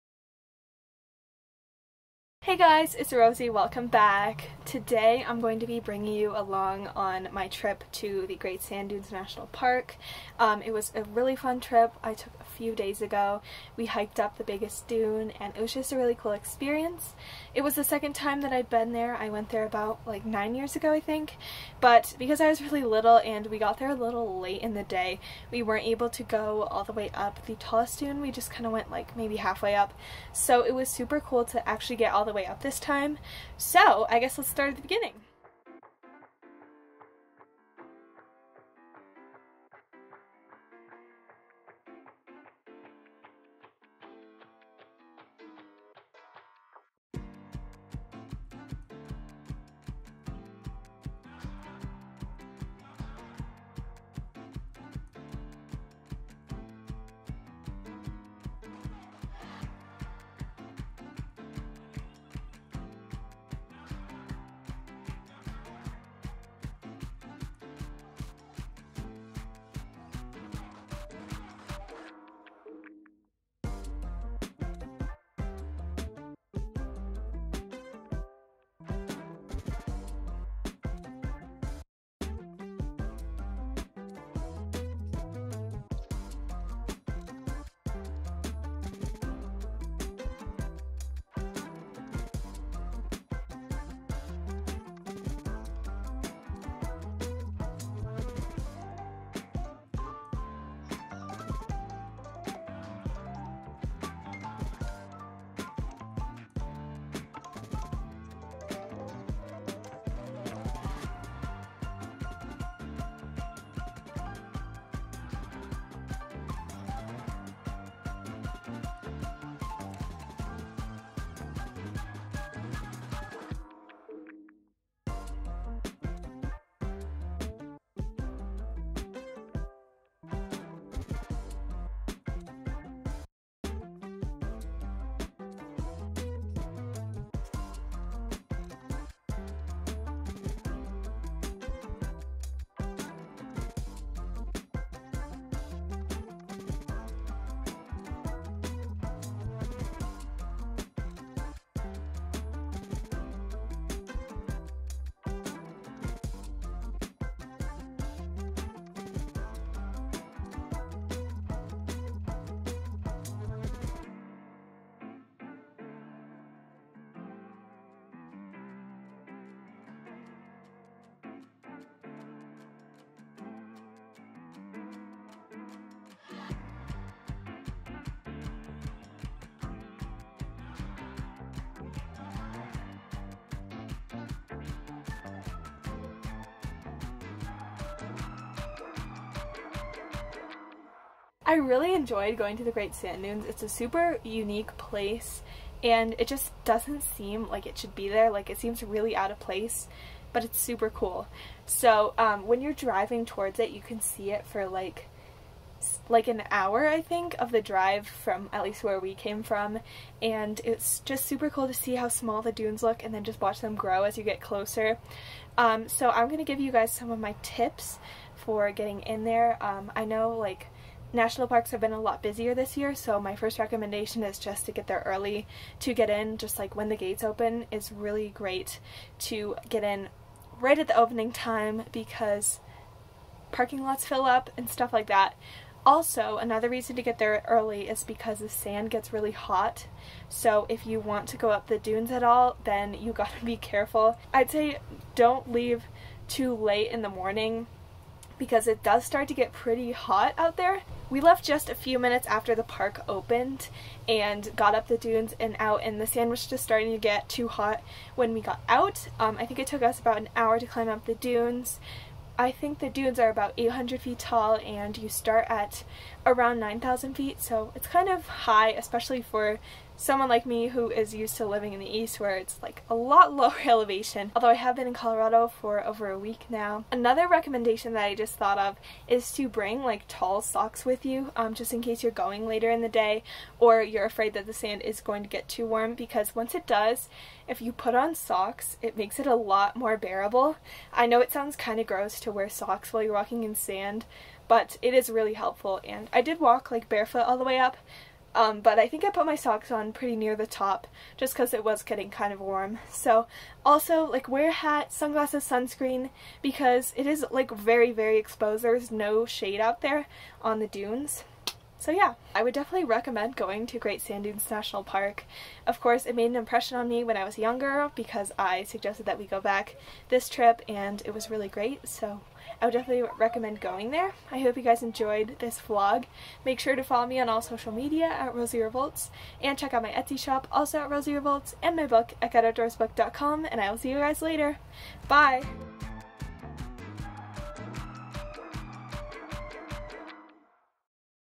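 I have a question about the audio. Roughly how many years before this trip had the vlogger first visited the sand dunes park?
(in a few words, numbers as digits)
9.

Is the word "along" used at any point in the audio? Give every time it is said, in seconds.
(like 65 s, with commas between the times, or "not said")
6 s.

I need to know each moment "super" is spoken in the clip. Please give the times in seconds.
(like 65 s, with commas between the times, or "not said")
30 s, 193 s, 200 s, 211 s.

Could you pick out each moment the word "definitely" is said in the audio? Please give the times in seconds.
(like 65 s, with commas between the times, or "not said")
312 s, 322 s.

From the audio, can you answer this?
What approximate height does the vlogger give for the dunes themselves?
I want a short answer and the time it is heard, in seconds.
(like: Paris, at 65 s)
800 feet, at 263 s.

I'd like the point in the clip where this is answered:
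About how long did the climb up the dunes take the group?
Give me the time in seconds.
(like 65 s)
259 s.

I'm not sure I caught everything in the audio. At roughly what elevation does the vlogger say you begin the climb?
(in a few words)
9,000 feet.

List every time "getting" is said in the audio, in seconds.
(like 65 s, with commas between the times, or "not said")
218 s, 301 s.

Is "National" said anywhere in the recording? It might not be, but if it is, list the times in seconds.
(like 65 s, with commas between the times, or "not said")
9 s, 221 s, 314 s.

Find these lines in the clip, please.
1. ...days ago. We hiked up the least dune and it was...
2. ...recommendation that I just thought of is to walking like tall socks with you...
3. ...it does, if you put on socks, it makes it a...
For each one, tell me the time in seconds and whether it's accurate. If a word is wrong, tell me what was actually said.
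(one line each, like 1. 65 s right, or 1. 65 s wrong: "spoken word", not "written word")
1. 12 s wrong: "biggest", not "least"
2. 277 s wrong: "bring", not "walking"
3. 286 s right.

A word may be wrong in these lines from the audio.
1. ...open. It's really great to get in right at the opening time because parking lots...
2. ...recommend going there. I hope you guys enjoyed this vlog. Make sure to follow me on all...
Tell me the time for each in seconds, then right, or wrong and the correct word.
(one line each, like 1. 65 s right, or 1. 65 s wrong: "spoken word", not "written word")
1. 227 s right
2. 323 s right.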